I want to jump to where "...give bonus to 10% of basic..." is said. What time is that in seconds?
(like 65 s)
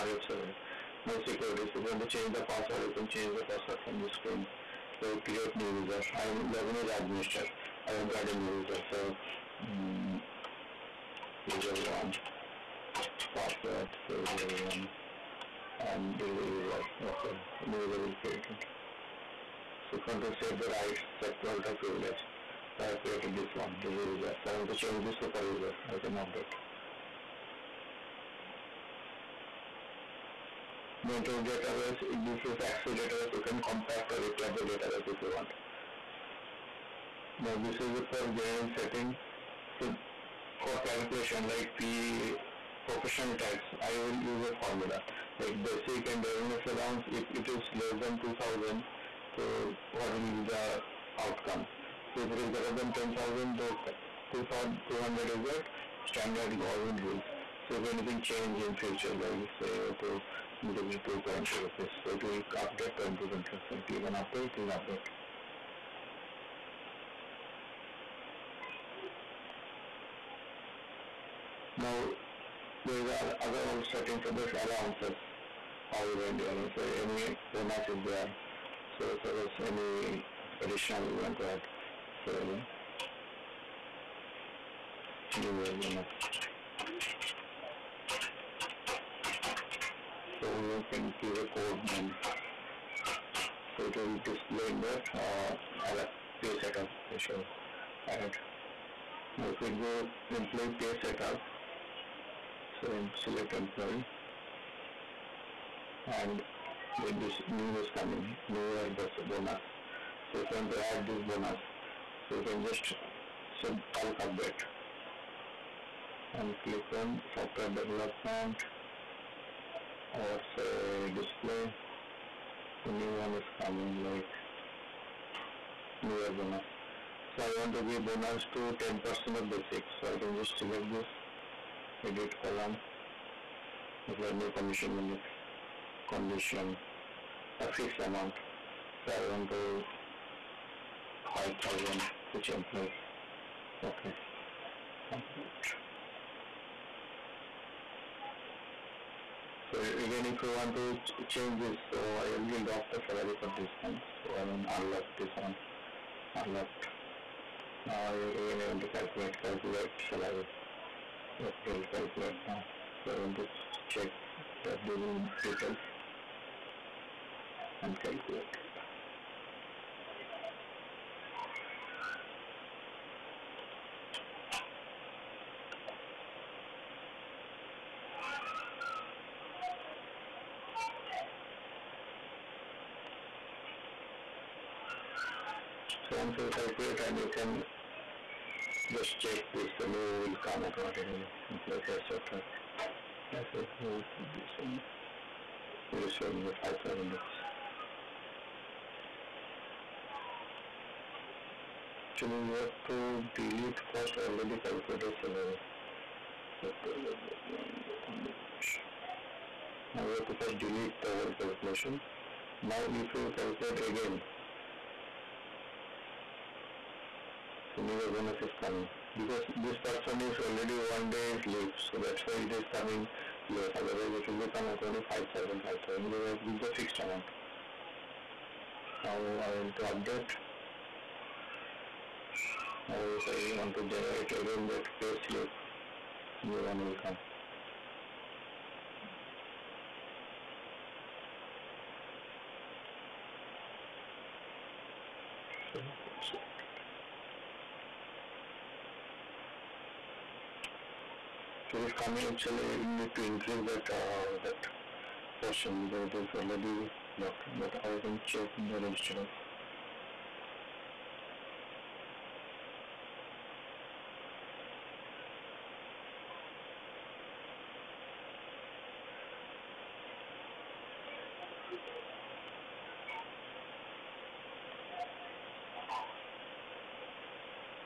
127 s.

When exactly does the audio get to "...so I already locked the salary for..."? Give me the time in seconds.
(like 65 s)
151 s.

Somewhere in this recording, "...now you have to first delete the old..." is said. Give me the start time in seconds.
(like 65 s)
209 s.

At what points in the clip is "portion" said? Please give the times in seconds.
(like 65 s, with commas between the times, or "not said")
255 s.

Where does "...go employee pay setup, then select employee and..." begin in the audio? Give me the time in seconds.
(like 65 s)
99 s.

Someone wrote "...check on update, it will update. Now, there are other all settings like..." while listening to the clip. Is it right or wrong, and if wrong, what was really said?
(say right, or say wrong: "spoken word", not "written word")
wrong: "click", not "check".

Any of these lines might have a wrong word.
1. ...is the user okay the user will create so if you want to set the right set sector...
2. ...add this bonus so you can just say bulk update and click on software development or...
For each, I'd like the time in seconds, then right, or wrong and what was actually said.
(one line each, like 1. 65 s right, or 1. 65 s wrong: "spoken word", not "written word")
1. 16 s right
2. 110 s right.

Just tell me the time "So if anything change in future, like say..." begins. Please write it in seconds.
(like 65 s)
57 s.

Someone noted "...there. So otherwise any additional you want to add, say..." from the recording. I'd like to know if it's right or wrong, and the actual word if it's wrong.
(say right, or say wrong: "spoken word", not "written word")
wrong: "suppose", not "otherwise".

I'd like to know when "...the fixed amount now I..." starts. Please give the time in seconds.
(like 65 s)
226 s.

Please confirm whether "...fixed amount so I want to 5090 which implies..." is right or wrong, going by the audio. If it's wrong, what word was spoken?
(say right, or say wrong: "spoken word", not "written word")
wrong: "5000", not "5090".